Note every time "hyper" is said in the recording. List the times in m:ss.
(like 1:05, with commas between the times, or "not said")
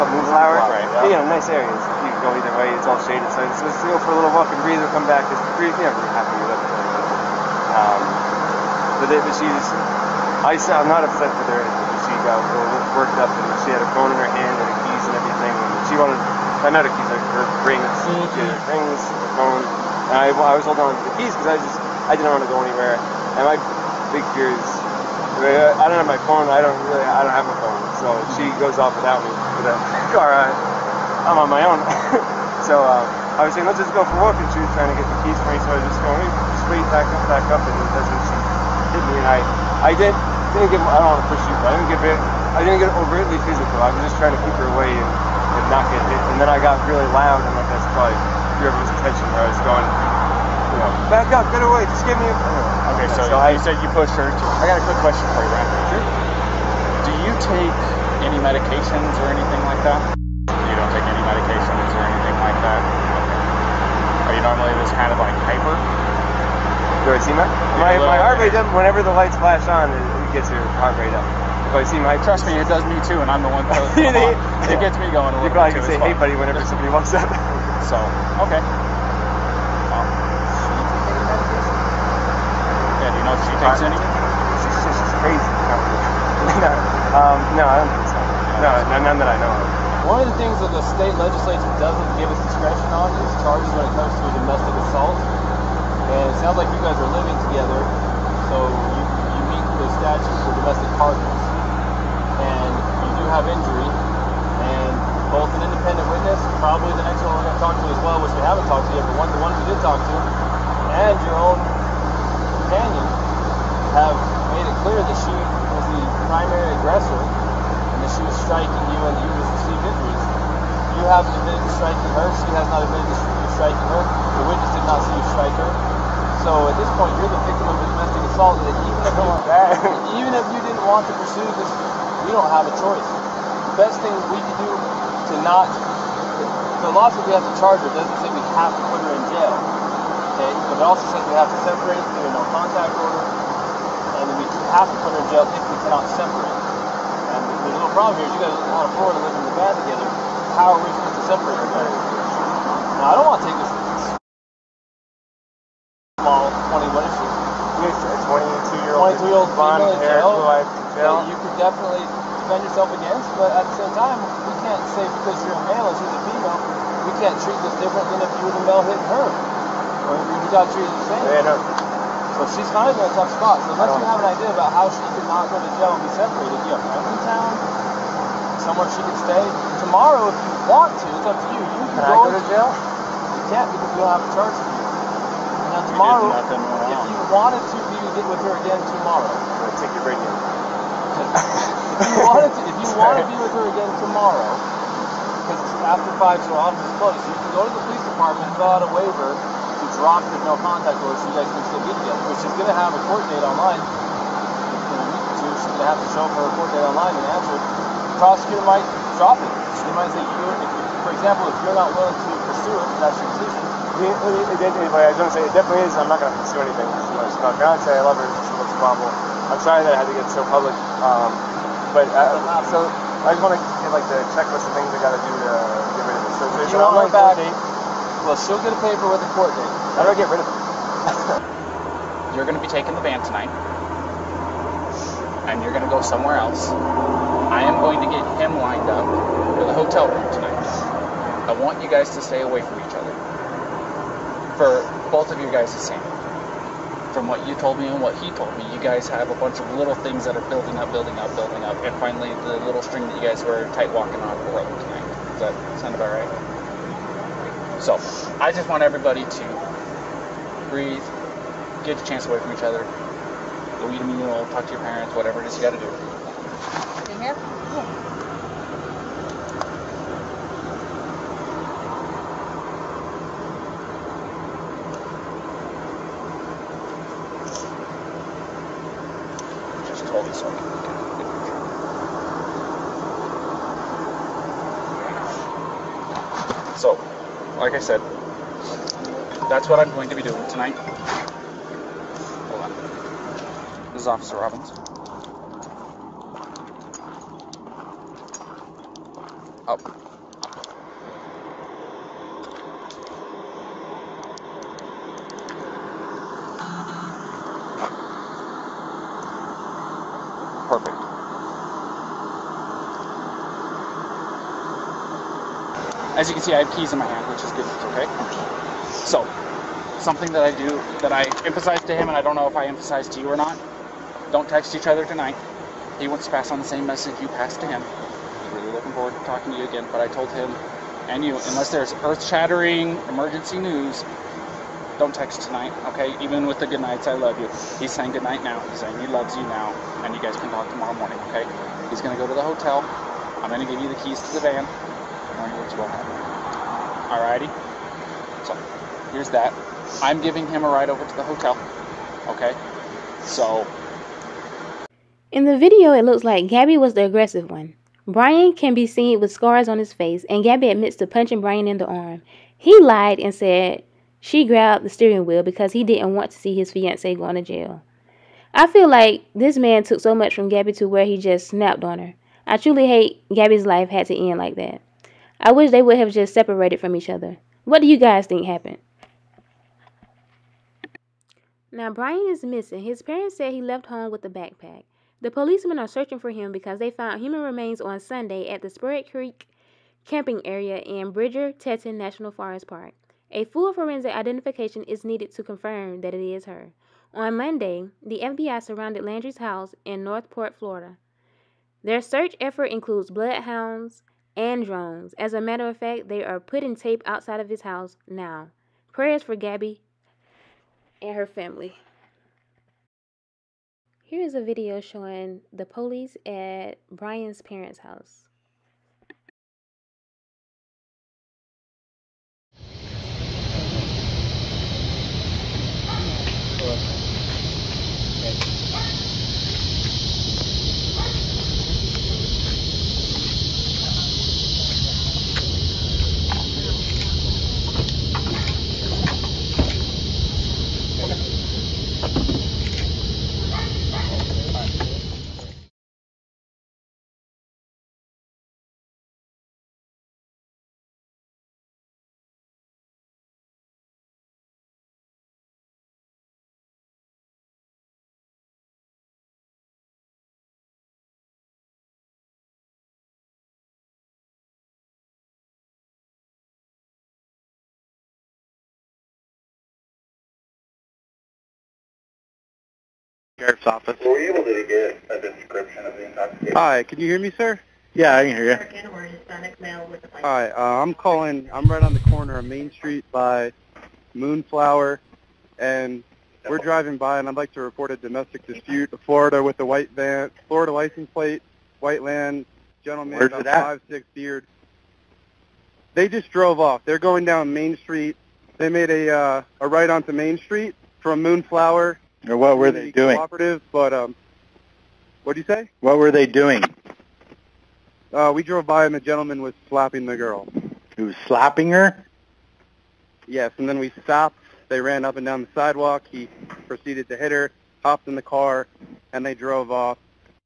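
1:05.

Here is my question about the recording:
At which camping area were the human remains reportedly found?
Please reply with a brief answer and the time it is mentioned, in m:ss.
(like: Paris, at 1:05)
Spirit Creek, at 6:28.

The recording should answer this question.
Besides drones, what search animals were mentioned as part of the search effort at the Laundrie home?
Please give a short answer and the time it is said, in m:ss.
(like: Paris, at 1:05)
bloodhounds, at 6:43.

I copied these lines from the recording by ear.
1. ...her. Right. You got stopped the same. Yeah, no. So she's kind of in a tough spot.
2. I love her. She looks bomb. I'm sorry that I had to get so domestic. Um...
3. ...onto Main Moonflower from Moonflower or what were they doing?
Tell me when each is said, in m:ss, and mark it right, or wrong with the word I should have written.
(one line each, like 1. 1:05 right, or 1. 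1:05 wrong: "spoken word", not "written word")
1. 2:49 wrong: "treated", not "stopped"
2. 3:37 wrong: "public", not "domestic"
3. 8:19 wrong: "Street", not "Moonflower".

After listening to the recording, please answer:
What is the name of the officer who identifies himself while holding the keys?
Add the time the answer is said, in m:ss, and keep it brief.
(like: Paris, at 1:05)
Officer Robbins, at 4:54.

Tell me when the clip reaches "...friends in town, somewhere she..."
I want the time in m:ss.
2:56.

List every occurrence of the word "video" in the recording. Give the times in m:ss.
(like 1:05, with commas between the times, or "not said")
5:55, 6:54.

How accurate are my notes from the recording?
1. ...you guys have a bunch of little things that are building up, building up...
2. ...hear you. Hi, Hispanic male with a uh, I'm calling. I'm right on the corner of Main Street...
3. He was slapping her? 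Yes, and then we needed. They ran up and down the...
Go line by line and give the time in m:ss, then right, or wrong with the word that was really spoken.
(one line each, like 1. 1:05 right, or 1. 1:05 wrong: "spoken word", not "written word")
1. 4:08 right
2. 7:58 right
3. 8:30 wrong: "stopped", not "needed".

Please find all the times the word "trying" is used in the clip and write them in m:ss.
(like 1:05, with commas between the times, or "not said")
0:34, 0:44.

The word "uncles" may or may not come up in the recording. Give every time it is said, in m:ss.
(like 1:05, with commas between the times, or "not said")
not said.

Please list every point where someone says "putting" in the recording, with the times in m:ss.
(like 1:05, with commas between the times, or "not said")
6:46.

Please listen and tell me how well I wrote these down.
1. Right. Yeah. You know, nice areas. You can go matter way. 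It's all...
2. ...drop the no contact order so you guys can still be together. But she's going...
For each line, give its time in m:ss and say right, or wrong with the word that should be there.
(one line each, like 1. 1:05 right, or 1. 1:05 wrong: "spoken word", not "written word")
1. 0:00 wrong: "either", not "matter"
2. 3:20 right.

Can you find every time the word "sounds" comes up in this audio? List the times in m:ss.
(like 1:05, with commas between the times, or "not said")
1:36, 4:15.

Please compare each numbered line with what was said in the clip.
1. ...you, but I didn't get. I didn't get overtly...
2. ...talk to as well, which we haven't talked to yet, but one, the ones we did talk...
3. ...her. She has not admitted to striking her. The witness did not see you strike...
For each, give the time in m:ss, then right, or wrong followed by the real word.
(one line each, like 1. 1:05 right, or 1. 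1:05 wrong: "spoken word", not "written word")
1. 0:41 right
2. 1:47 right
3. 2:02 right.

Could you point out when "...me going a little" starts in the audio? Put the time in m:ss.
1:14.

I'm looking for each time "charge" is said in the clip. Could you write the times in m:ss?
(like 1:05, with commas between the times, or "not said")
1:33, 2:17, 3:04.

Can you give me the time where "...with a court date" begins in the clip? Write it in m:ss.
3:49.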